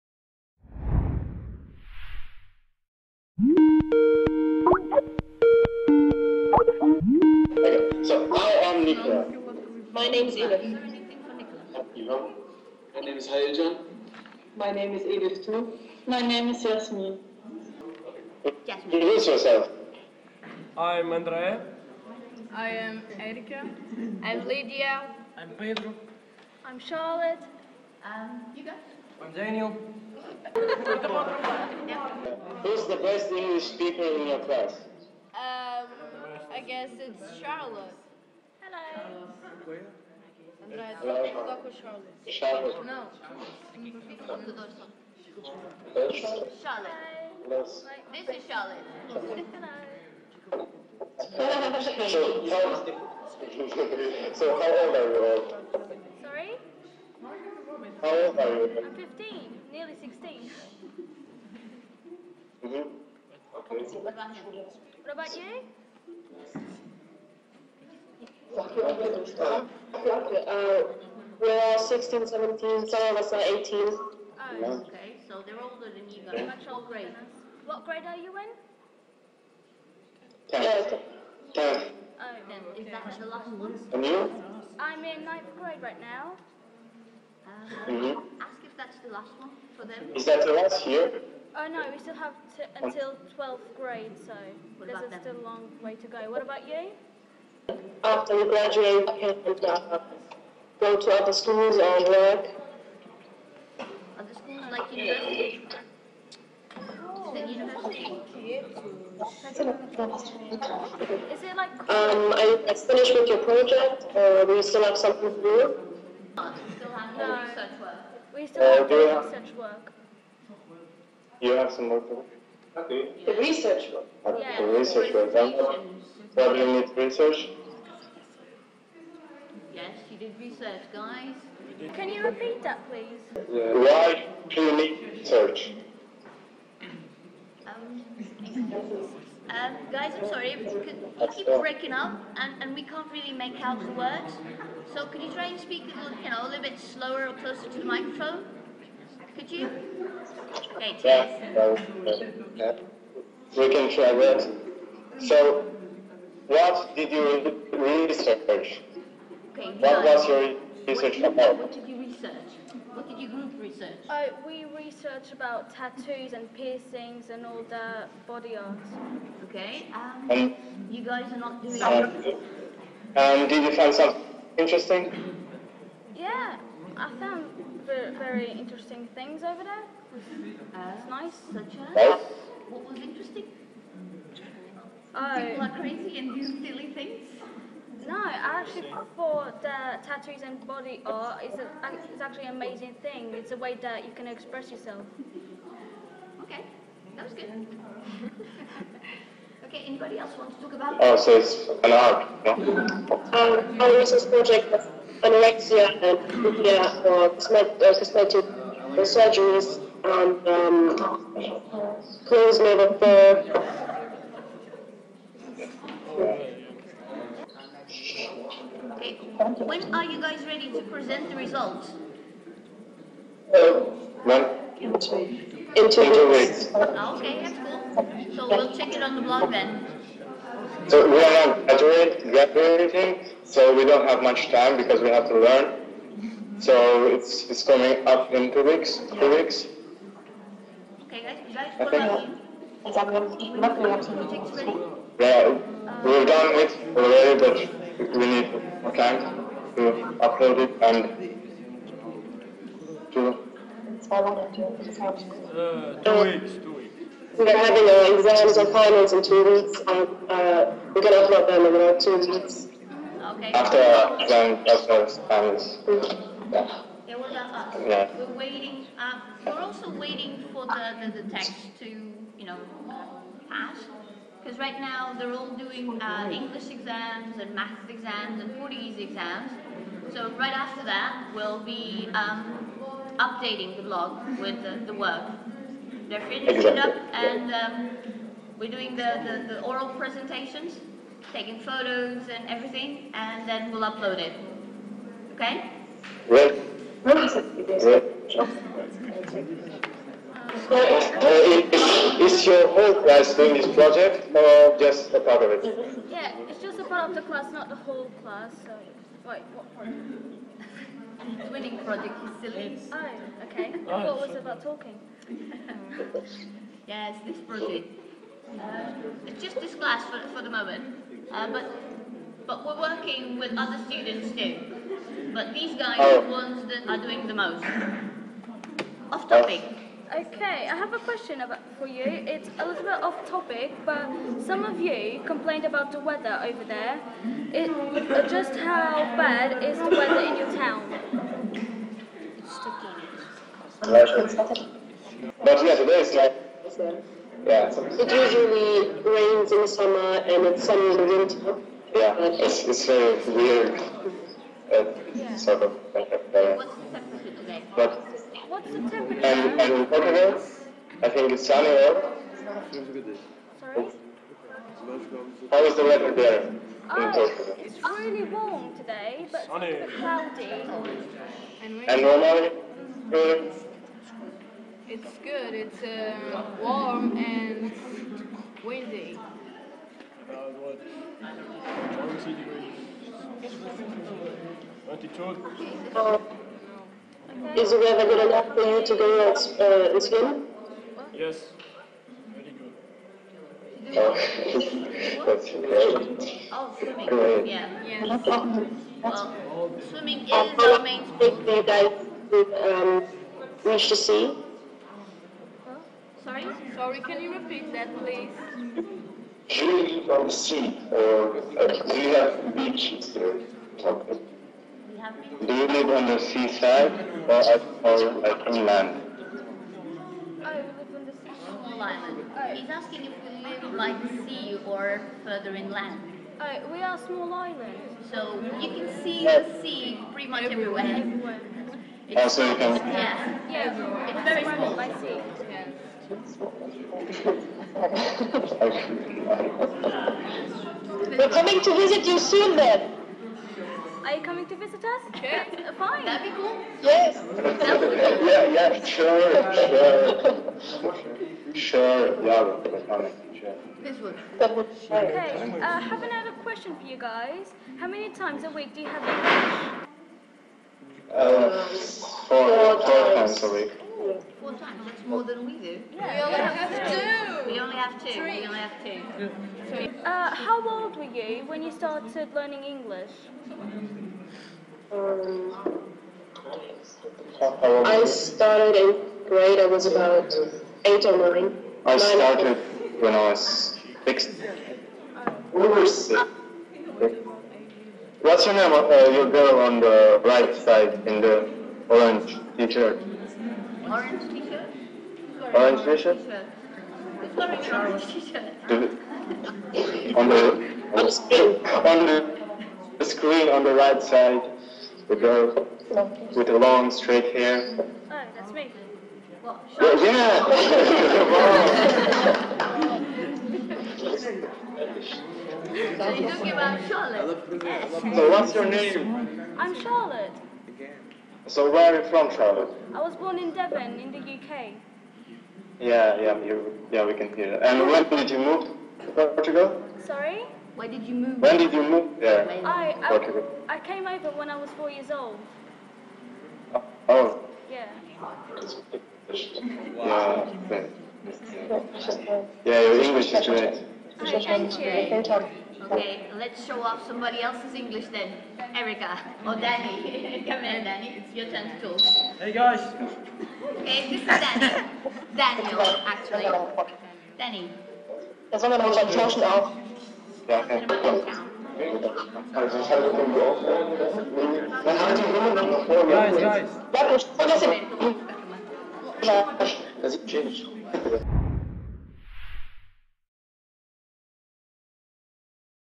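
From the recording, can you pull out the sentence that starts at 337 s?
It, just how bad is the weather in your town?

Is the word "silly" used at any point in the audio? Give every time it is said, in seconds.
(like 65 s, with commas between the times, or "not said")
186 s, 312 s.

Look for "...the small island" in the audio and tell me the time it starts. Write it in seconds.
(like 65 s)
421 s.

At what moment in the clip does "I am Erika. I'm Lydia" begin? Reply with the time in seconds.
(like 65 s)
22 s.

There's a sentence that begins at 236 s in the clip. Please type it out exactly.
So it's, it's coming up in two weeks, Two weeks.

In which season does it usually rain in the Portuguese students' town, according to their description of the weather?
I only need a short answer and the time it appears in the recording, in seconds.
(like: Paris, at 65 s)
Summer, at 349 s.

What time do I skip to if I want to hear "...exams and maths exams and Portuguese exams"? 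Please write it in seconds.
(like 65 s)
276 s.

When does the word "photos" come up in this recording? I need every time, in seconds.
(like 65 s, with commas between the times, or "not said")
291 s.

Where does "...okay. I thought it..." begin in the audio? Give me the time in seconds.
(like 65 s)
313 s.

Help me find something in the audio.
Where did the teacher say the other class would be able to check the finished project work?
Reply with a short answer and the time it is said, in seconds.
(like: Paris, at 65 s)
On the blog, at 229 s.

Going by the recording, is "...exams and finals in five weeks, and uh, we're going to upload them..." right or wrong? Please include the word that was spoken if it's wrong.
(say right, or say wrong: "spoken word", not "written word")
wrong: "two", not "five".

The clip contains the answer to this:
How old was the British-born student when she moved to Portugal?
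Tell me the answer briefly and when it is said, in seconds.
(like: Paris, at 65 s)
4, at 534 s.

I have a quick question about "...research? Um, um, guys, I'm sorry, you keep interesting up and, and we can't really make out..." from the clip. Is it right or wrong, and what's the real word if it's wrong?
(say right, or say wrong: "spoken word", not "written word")
wrong: "breaking", not "interesting".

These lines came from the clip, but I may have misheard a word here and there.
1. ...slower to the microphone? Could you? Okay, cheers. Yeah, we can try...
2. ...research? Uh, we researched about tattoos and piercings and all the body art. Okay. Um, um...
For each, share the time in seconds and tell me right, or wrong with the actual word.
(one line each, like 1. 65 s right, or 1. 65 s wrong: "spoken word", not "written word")
1. 147 s wrong: "closer", not "slower"
2. 163 s right.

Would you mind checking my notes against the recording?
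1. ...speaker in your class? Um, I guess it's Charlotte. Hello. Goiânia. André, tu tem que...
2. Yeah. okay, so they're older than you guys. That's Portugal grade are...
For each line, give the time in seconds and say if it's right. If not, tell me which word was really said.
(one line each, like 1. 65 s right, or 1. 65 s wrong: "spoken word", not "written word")
1. 33 s right
2. 73 s wrong: "What", not "Portugal".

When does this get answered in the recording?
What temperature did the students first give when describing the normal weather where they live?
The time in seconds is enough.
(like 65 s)
382 s.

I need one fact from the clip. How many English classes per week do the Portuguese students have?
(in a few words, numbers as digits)
4.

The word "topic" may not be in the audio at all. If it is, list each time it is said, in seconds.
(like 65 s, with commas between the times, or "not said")
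329 s, 333 s.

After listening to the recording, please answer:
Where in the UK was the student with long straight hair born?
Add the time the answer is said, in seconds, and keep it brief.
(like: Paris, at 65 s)
Devon, at 523 s.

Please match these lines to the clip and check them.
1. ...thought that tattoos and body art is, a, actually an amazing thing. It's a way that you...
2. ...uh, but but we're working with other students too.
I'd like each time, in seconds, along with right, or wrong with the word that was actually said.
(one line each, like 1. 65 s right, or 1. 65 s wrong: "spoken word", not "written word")
1. 189 s right
2. 321 s right.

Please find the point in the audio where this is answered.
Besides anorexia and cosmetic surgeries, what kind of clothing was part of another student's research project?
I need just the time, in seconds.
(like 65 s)
212 s.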